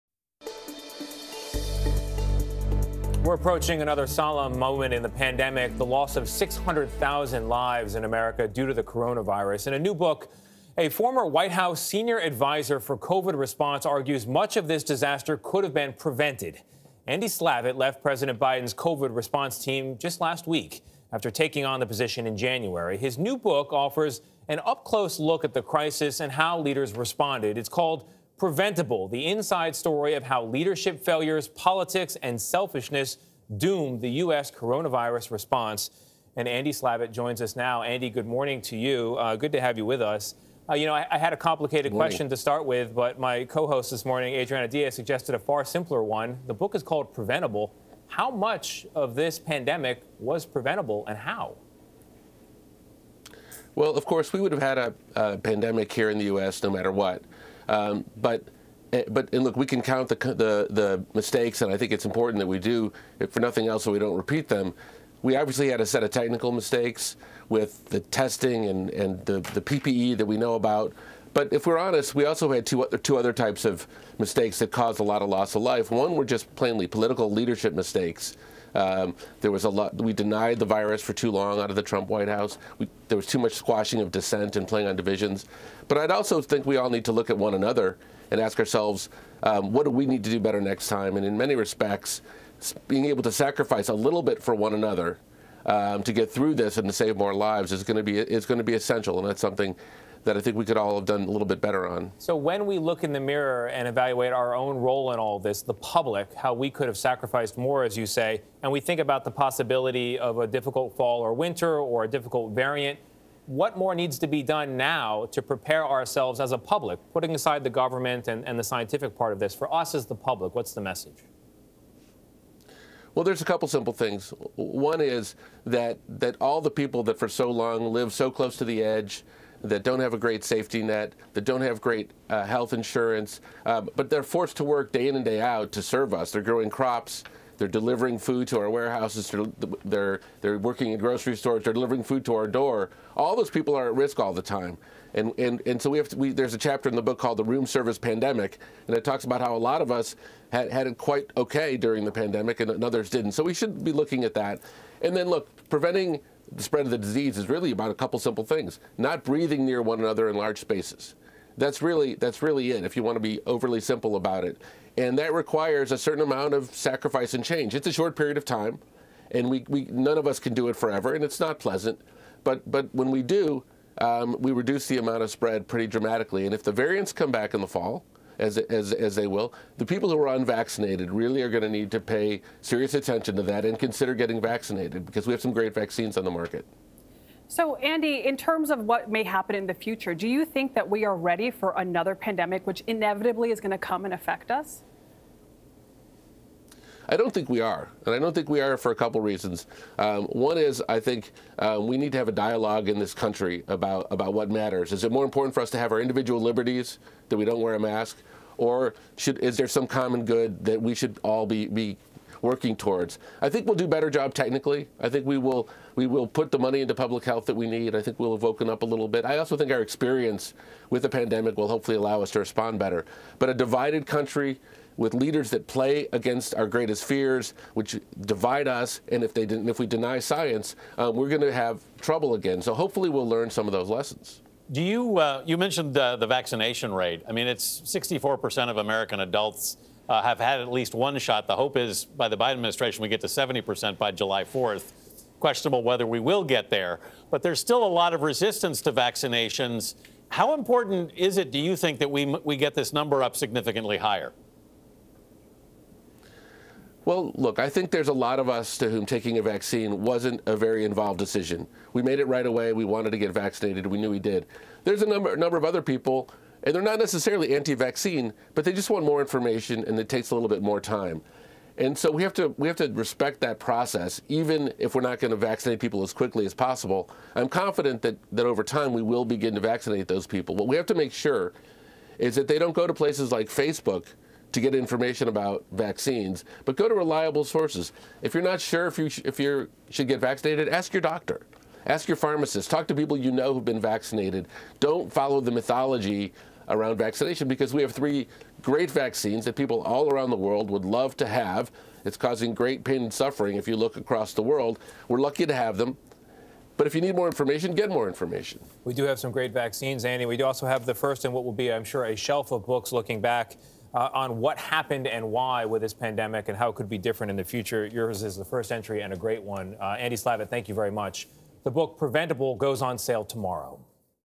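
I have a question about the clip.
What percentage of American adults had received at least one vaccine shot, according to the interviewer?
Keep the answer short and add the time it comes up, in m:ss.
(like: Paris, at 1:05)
64%, at 3:57.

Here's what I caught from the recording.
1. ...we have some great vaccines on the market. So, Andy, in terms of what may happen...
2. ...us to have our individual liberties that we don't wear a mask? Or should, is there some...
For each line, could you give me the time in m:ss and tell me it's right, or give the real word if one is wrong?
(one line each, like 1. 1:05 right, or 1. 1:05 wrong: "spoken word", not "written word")
1. 3:05 right
2. 3:25 right.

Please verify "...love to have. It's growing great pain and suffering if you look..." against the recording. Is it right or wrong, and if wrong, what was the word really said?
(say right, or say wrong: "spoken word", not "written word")
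wrong: "causing", not "growing".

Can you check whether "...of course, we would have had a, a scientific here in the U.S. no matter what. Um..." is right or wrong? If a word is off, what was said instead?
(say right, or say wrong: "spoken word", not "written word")
wrong: "pandemic", not "scientific".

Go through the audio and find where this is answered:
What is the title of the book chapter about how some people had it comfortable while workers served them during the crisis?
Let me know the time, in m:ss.
2:27.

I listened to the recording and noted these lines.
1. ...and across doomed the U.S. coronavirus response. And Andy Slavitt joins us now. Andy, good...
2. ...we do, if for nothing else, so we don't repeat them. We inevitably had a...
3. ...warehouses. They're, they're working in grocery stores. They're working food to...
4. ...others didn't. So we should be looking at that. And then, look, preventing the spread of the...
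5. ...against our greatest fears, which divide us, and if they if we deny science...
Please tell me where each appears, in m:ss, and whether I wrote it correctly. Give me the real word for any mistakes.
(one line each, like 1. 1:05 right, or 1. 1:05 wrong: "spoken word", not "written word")
1. 0:32 wrong: "selfishness", not "across"
2. 1:02 wrong: "obviously", not "inevitably"
3. 2:18 wrong: "delivering", not "working"
4. 2:32 right
5. 3:46 right.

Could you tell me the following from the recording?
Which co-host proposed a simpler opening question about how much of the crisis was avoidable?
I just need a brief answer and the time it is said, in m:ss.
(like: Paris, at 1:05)
Adriana Diaz, at 0:44.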